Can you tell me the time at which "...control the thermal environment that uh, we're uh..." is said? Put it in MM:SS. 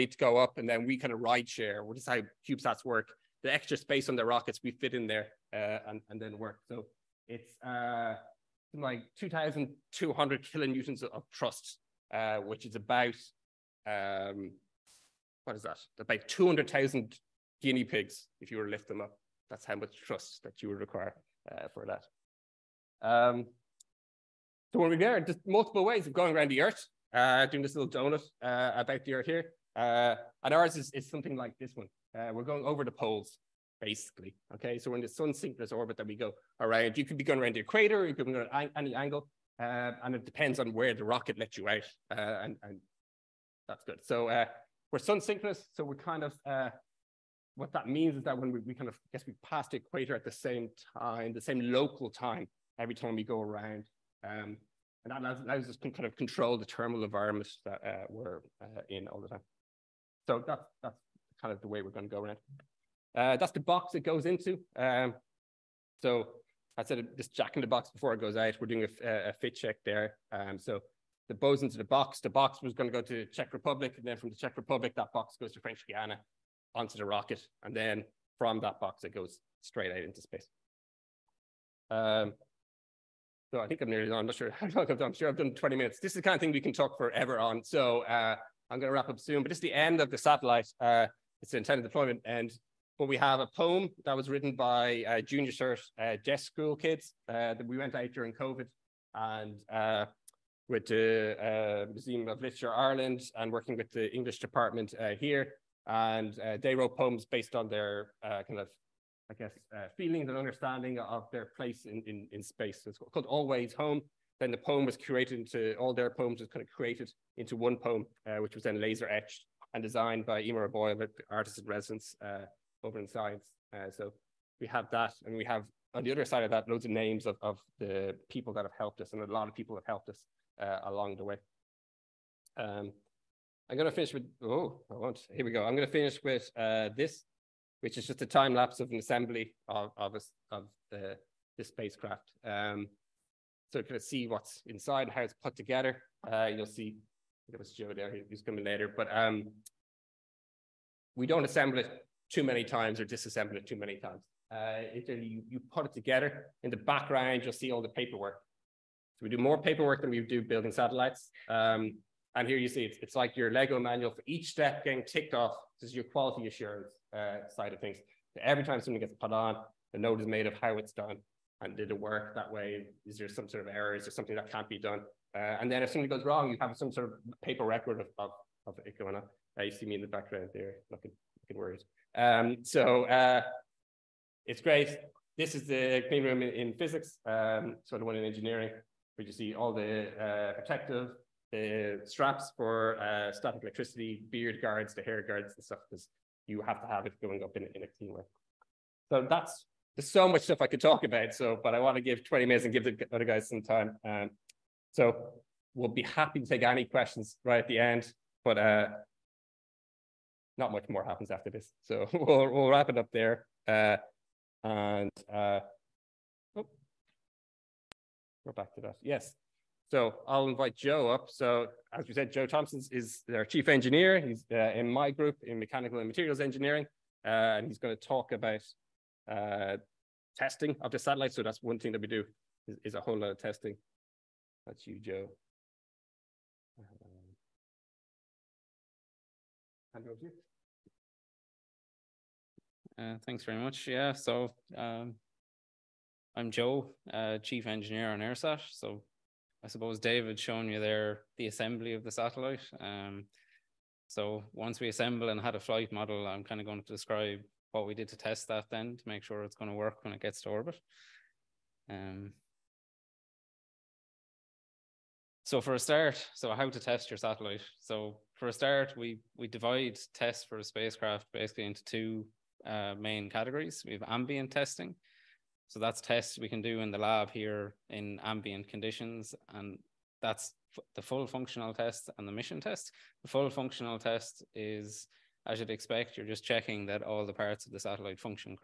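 00:56.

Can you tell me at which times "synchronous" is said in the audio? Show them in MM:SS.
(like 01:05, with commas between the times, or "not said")
00:35, 00:45.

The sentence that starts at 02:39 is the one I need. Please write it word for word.
So we do more paperwork than we do building satellites.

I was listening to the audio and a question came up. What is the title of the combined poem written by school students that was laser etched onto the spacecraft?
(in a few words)
Always Home.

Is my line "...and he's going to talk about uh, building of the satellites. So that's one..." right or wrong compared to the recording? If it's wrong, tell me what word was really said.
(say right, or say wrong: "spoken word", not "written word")
wrong: "testing", not "building".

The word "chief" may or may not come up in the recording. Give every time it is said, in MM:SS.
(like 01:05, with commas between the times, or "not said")
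03:43, 04:07.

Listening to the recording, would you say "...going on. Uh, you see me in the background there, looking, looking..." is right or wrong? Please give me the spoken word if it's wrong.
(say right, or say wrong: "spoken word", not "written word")
right.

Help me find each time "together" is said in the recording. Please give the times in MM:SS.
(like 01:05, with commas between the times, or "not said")
02:25, 02:35.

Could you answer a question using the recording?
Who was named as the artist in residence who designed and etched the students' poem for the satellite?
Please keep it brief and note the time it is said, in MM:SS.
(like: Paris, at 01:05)
Emer Boyle, at 02:00.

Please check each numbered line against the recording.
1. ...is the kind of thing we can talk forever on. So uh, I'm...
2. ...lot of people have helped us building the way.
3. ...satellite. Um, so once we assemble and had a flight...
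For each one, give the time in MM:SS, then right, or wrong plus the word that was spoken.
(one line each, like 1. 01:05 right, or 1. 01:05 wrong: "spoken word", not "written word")
1. 01:26 right
2. 02:09 wrong: "along", not "building"
3. 04:12 right.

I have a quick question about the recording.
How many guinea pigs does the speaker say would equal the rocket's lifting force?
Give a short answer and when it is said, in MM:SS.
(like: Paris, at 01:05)
200,000, at 00:16.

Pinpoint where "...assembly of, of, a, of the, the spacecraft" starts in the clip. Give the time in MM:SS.
02:18.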